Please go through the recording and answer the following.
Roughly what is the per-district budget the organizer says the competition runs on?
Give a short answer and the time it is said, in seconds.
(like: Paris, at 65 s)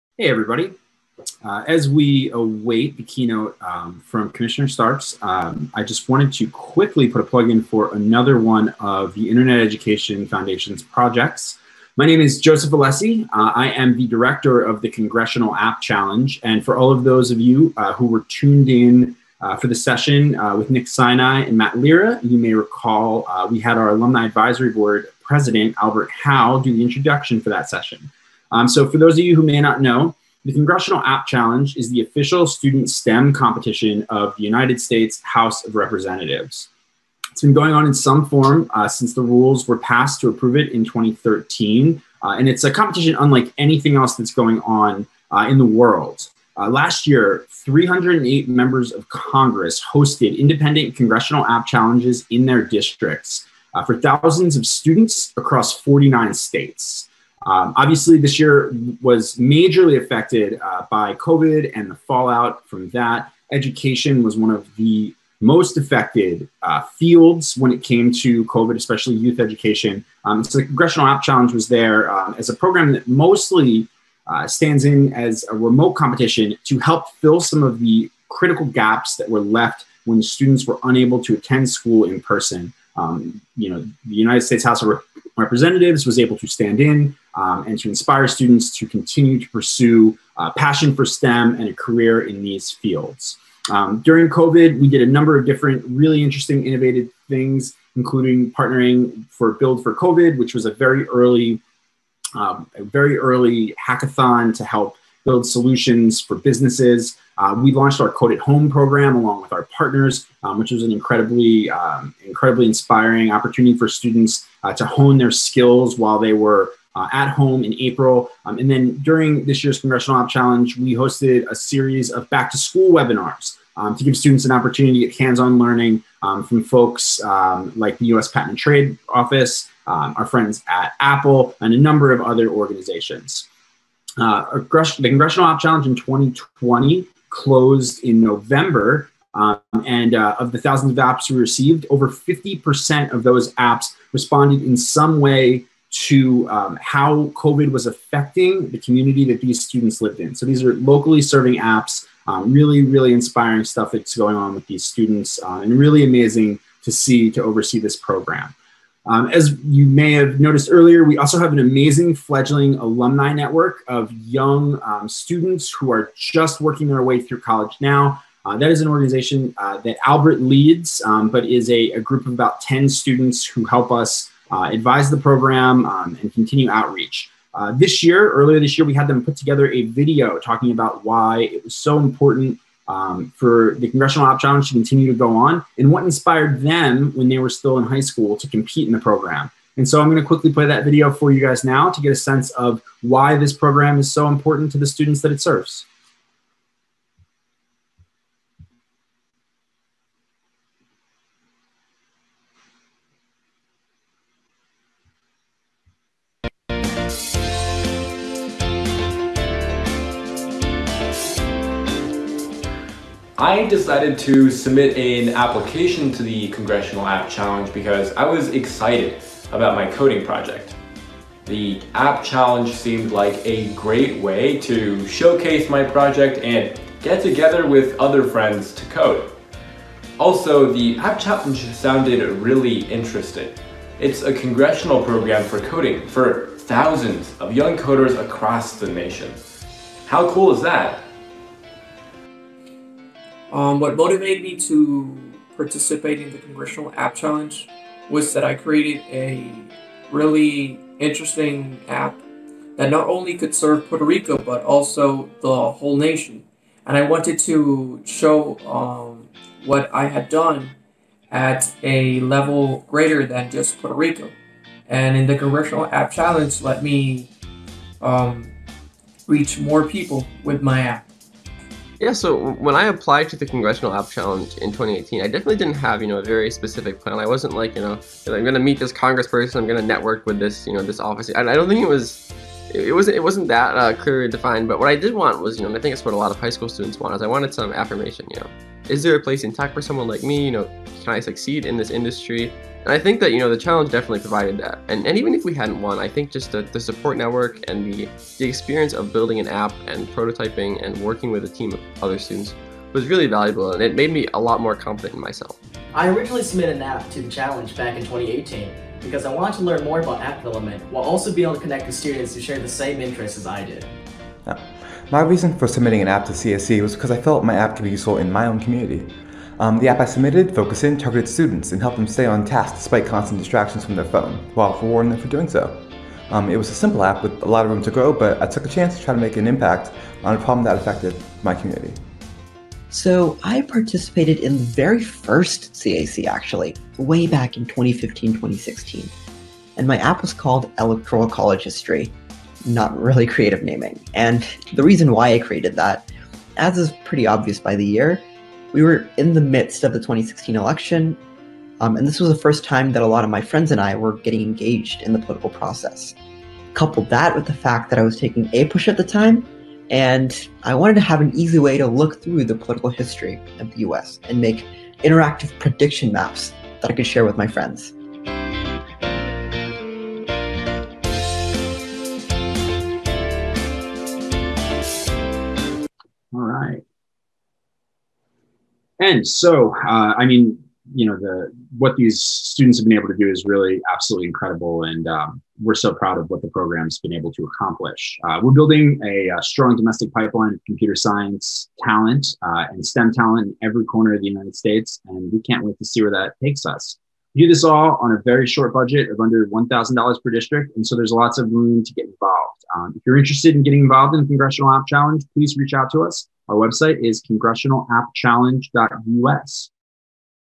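under $1,000, at 399 s.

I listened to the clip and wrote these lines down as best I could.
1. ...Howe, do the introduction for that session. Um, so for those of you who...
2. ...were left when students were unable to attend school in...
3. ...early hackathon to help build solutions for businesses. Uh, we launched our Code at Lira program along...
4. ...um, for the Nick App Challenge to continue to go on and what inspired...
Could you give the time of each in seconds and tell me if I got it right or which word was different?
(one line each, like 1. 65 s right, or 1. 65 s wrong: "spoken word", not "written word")
1. 26 s right
2. 79 s right
3. 103 s wrong: "Home", not "Lira"
4. 182 s wrong: "Congressional", not "Nick".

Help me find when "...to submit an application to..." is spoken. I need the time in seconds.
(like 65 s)
214 s.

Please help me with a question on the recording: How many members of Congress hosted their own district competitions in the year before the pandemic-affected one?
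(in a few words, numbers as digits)
308.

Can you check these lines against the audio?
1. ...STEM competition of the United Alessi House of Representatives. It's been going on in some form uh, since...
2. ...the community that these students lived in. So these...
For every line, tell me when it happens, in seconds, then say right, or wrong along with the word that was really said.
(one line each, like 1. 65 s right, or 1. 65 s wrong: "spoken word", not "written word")
1. 32 s wrong: "States", not "Alessi"
2. 148 s right.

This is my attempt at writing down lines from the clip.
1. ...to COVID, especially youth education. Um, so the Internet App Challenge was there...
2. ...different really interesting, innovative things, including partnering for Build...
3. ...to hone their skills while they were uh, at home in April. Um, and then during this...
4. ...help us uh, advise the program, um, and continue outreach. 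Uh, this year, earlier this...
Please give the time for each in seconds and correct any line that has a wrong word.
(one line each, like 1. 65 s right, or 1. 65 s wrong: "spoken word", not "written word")
1. 68 s wrong: "Congressional", not "Internet"
2. 95 s right
3. 114 s right
4. 173 s right.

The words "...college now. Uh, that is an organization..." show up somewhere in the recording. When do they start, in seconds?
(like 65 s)
167 s.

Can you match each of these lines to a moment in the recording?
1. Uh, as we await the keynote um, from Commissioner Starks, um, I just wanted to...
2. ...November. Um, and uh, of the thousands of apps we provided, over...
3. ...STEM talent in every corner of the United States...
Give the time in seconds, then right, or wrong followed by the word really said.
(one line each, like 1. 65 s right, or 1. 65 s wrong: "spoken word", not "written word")
1. 1 s right
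2. 138 s wrong: "received", not "provided"
3. 392 s right.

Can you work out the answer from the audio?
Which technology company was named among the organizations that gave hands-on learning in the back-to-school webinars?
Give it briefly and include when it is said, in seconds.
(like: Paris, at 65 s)
Apple, at 130 s.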